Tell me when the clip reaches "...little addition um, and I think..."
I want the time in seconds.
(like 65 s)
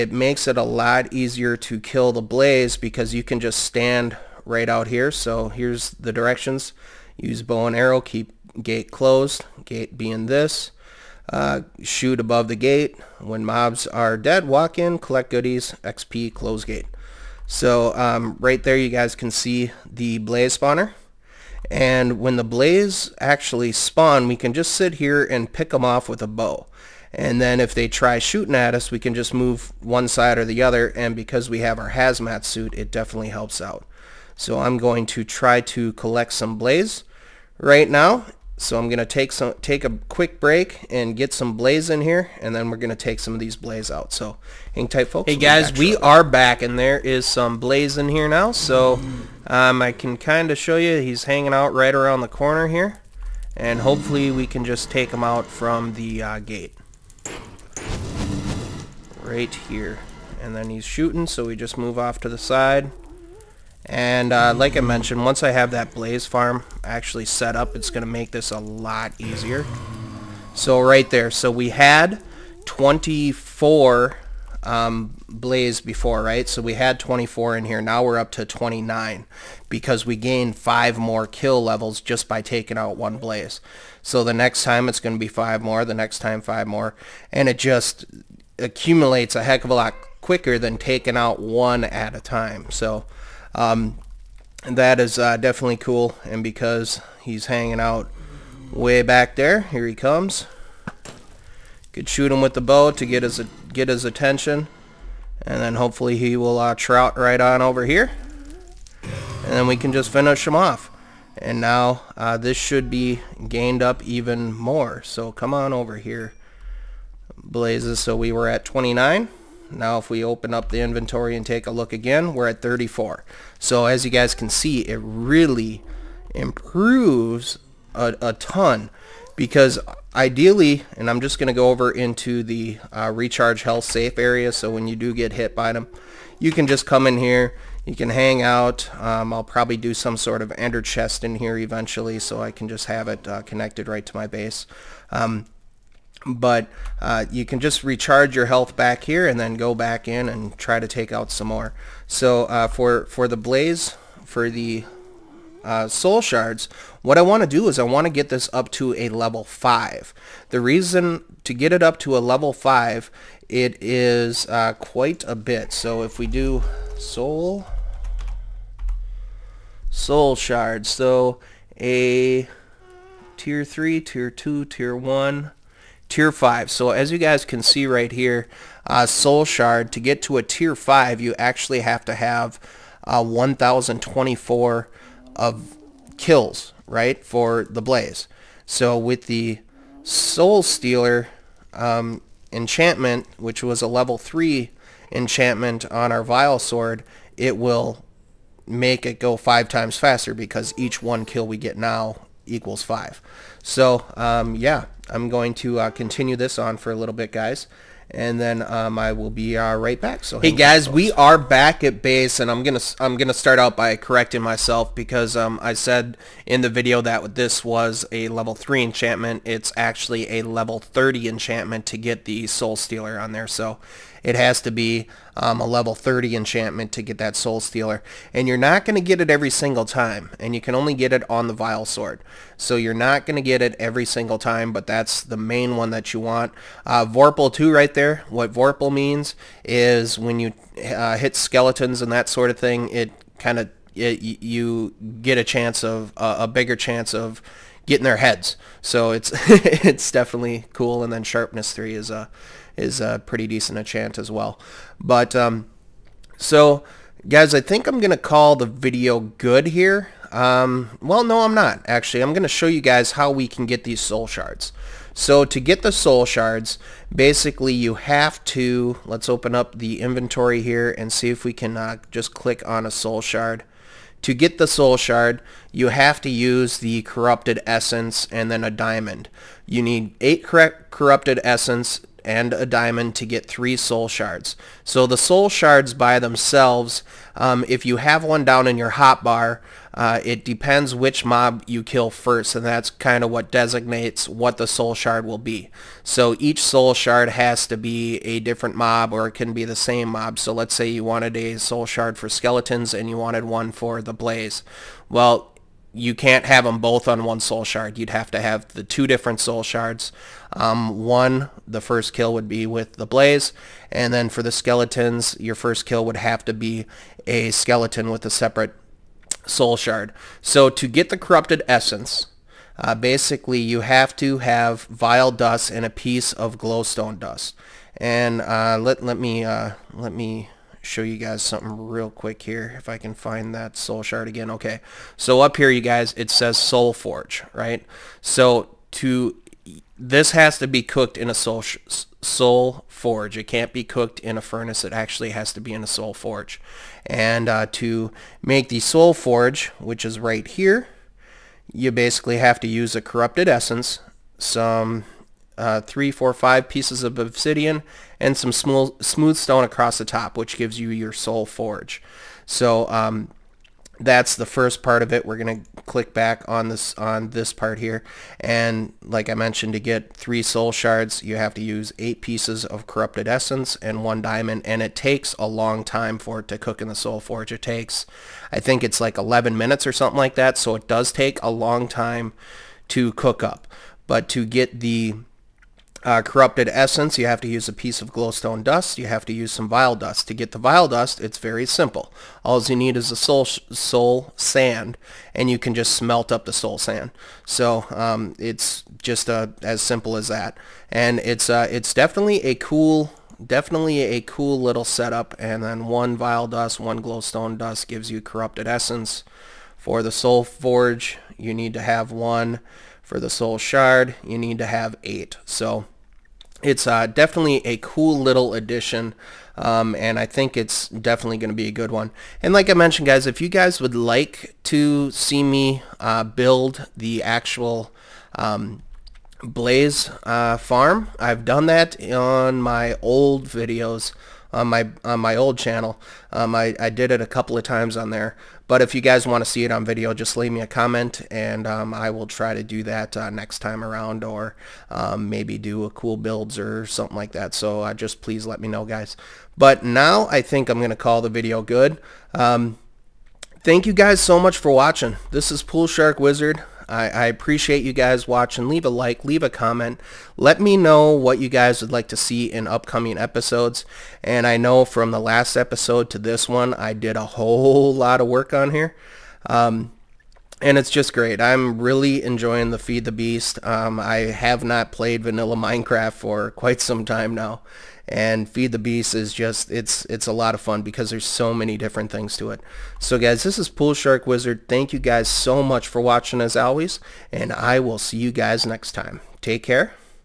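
418 s.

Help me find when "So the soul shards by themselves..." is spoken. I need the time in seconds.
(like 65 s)
284 s.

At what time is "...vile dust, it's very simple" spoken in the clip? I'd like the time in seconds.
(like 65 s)
390 s.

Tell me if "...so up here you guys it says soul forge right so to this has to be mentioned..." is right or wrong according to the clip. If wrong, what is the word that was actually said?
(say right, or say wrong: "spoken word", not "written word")
wrong: "cooked", not "mentioned".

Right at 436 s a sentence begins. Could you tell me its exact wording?
Um, I, I did it a couple of times on there.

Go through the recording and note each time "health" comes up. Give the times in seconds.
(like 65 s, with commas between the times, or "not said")
133 s, 148 s.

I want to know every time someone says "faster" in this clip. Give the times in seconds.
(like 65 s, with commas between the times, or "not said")
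199 s.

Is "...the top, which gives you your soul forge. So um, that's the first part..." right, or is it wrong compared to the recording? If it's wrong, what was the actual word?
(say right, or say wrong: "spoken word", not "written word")
right.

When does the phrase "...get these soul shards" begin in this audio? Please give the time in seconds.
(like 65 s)
263 s.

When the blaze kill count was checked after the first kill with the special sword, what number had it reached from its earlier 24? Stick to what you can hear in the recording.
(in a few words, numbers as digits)
29.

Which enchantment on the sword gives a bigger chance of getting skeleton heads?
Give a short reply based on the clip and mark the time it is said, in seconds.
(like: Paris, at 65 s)
Vorpal 2, at 237 s.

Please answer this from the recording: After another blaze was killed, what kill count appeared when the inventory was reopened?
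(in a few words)
34.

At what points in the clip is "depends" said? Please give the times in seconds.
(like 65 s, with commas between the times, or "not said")
290 s.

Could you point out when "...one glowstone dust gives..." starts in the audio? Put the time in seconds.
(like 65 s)
406 s.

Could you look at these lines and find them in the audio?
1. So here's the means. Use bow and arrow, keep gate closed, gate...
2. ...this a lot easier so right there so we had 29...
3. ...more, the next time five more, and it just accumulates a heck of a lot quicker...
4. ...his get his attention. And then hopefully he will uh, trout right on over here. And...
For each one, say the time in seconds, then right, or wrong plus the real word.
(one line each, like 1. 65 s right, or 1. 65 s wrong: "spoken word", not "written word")
1. 5 s wrong: "directions", not "means"
2. 68 s wrong: "24", not "29"
3. 85 s right
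4. 103 s right.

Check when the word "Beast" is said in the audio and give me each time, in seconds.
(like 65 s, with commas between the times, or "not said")
473 s, 478 s.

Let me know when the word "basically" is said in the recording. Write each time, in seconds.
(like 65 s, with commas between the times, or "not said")
267 s, 322 s, 351 s.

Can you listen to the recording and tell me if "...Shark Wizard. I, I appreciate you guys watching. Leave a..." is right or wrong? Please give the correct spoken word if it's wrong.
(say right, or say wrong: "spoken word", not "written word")
right.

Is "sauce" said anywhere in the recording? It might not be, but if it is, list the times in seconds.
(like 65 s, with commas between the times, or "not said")
not said.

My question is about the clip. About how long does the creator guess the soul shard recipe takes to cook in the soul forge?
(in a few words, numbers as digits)
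11 minutes.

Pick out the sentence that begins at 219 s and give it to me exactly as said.
It's actually a level 30 enchantment to get the Soul Stealer on there.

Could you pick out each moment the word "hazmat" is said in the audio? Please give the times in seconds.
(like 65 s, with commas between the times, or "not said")
31 s.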